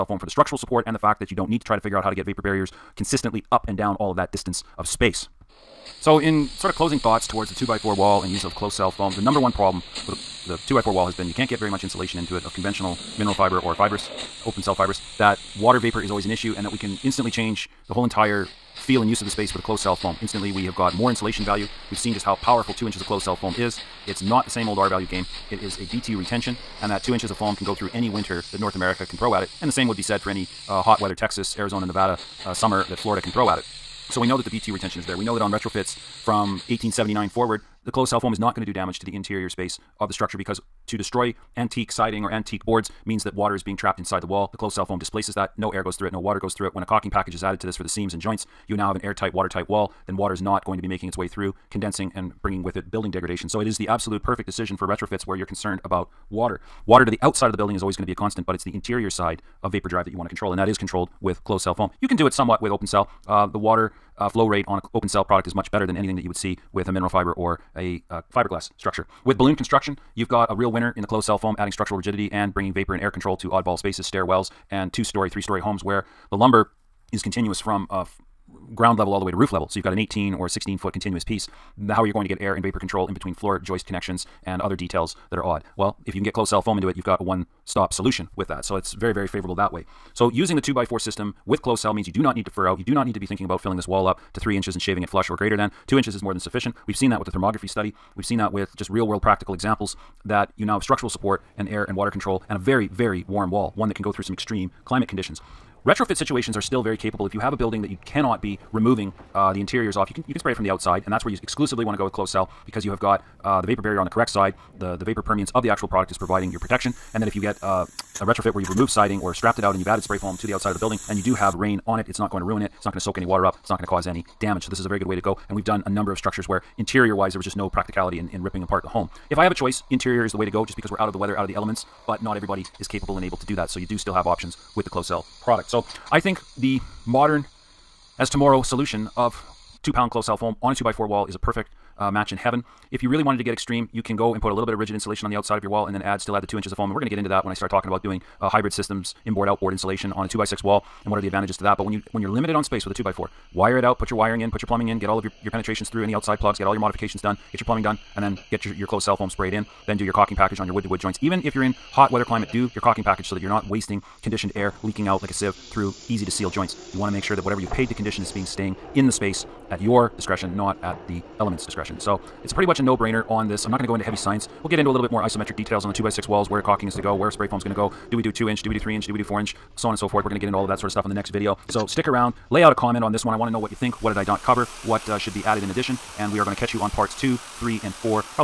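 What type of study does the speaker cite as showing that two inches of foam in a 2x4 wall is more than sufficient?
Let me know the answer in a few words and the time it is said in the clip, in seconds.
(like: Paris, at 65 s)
thermography study, at 97 s.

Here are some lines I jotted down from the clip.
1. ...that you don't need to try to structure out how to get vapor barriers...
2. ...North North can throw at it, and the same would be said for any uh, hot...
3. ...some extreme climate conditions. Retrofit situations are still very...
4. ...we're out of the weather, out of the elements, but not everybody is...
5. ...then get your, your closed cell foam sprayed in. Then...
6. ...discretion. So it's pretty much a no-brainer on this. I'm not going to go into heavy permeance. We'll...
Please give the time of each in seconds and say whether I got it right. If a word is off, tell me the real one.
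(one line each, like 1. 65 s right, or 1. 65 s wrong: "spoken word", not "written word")
1. 1 s wrong: "figure", not "structure"
2. 28 s wrong: "America", not "North"
3. 104 s right
4. 130 s right
5. 158 s right
6. 171 s wrong: "science", not "permeance".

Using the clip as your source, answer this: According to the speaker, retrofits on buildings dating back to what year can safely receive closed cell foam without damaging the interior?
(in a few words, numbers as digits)
1879.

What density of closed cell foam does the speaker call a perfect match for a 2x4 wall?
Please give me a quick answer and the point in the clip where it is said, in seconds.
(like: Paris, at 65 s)
two pound, at 139 s.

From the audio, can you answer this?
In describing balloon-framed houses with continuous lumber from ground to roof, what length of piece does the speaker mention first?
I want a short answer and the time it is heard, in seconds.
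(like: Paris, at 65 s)
18 foot, at 79 s.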